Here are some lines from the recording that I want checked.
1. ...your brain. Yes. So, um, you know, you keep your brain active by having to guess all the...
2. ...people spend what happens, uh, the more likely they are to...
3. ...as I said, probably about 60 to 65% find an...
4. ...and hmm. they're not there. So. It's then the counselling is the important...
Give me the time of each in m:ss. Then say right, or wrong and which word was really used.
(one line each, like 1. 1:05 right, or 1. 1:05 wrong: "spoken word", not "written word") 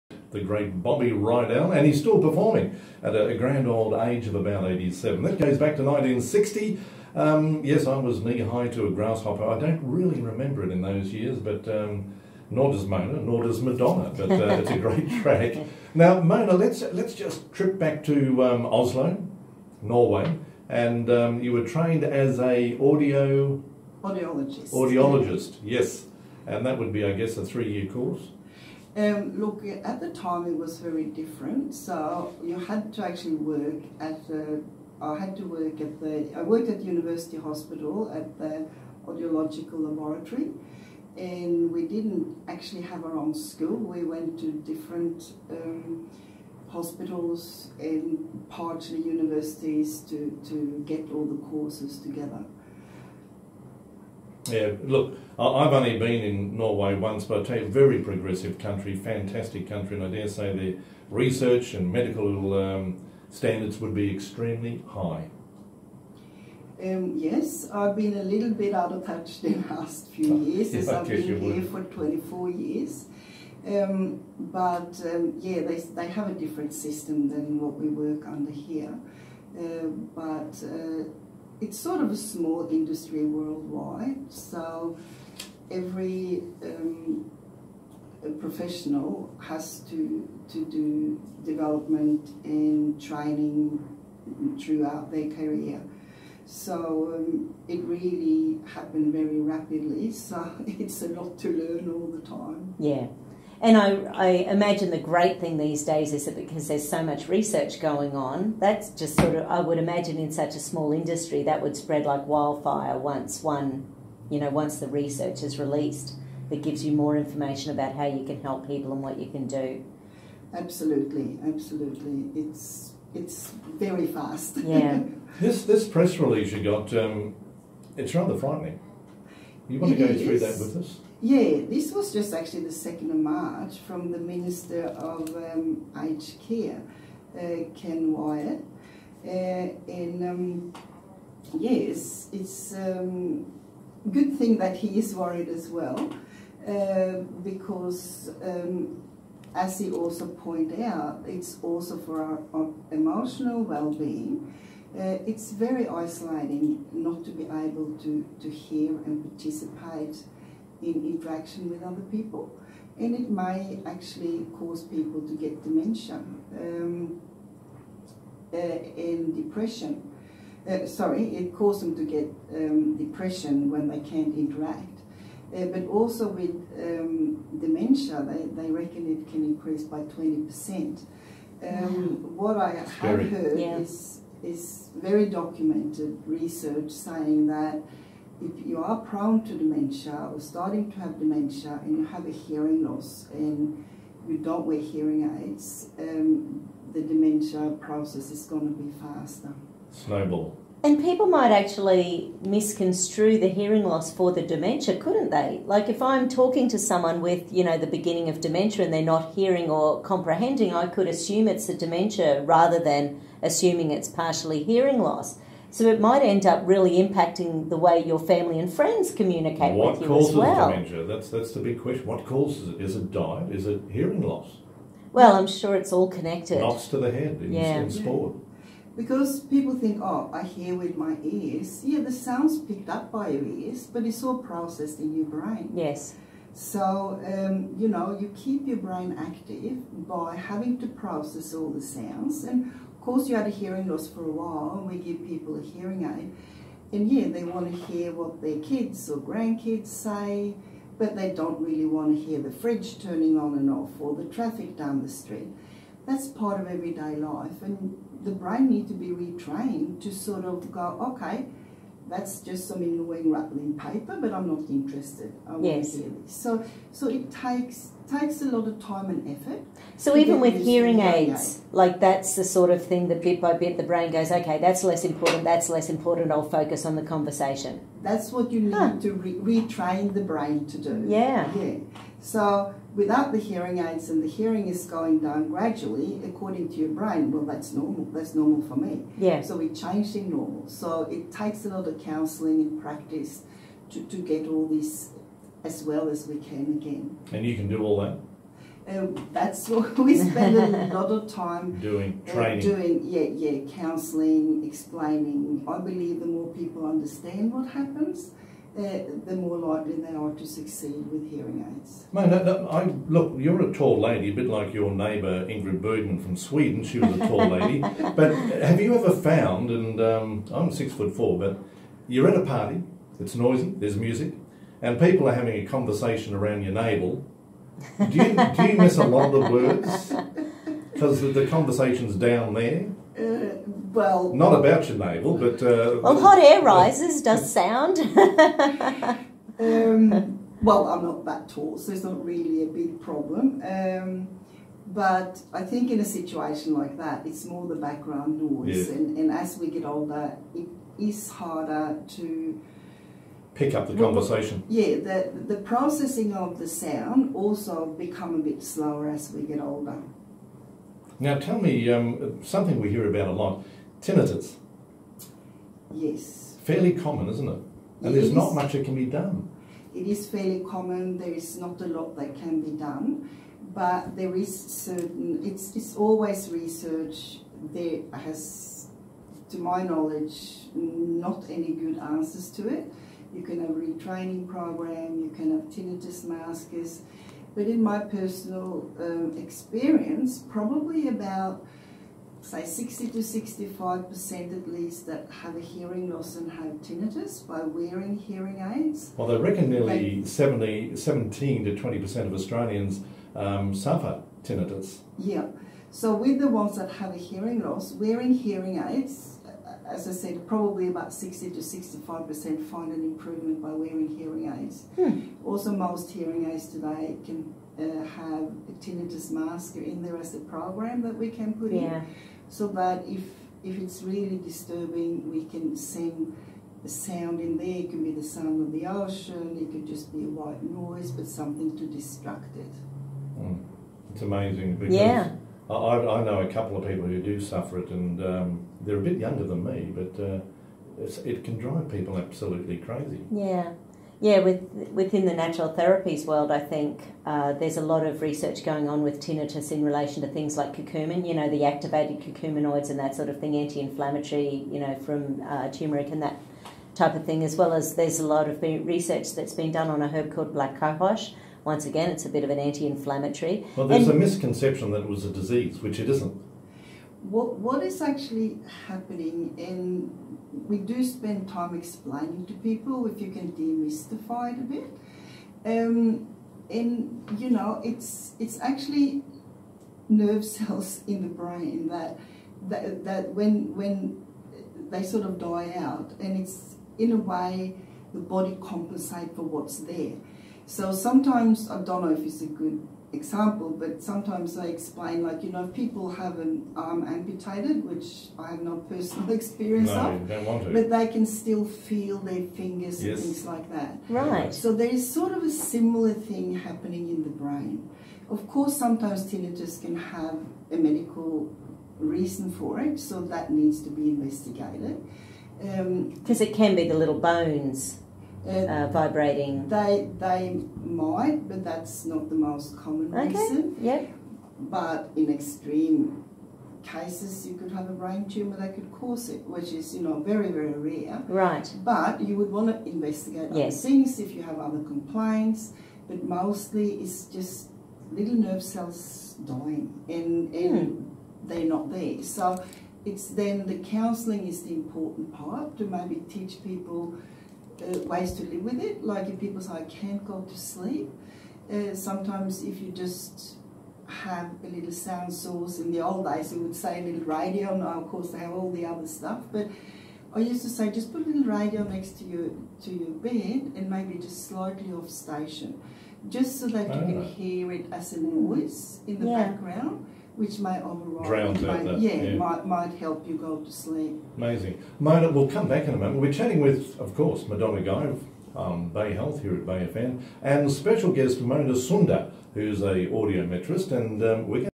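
1. 3:55 wrong: "process", not "guess"
2. 5:06 wrong: "understand", not "spend"
3. 6:49 right
4. 9:00 right.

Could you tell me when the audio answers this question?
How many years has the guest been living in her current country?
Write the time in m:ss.
1:11.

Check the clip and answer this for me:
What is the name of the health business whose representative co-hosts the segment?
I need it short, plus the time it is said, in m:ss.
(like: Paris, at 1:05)
Bay Health, at 9:38.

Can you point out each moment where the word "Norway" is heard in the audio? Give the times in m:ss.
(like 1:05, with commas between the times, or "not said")
0:19, 0:56.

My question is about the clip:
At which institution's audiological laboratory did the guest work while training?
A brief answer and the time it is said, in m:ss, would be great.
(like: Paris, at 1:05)
University Hospital, at 0:36.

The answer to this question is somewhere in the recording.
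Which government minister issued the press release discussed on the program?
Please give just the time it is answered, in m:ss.
2:17.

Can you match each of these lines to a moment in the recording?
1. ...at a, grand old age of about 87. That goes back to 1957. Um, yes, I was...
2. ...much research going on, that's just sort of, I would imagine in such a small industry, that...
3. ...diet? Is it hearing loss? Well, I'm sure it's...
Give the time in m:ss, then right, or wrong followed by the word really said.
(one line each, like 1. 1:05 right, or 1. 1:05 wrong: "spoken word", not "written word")
1. 0:03 wrong: "1960", not "1957"
2. 1:47 right
3. 3:43 right.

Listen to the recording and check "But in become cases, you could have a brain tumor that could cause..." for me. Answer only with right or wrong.
wrong.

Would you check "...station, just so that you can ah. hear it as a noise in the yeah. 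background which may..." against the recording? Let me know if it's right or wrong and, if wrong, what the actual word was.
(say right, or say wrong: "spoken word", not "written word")
right.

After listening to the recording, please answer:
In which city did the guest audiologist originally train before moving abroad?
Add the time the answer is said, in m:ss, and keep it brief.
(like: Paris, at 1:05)
Oslo, at 0:18.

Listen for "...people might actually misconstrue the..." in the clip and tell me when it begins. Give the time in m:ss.
3:20.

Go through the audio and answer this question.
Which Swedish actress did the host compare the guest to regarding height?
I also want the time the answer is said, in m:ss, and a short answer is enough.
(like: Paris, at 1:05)
Ingrid Bergman, at 5:15.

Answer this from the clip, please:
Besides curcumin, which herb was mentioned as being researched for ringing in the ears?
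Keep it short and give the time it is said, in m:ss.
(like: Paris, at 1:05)
black cohosh, at 7:40.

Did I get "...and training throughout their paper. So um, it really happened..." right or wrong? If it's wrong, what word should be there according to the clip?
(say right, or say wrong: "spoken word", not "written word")
wrong: "career", not "paper".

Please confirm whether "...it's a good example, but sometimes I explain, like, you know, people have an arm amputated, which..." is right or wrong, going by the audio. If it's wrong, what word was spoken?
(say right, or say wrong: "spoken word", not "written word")
right.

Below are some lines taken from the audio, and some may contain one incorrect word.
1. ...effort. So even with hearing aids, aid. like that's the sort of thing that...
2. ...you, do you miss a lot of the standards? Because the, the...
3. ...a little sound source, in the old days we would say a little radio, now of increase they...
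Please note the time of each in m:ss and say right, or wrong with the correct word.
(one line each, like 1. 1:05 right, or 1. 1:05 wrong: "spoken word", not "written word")
1. 4:29 right
2. 5:28 wrong: "words", not "standards"
3. 9:14 wrong: "course", not "increase".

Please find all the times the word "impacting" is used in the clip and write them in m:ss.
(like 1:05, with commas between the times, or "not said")
3:37.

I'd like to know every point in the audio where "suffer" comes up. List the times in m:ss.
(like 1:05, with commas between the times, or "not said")
6:43, 7:17.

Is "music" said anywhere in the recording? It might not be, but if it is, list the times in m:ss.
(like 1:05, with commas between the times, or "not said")
5:23.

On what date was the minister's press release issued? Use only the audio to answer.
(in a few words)
2 March.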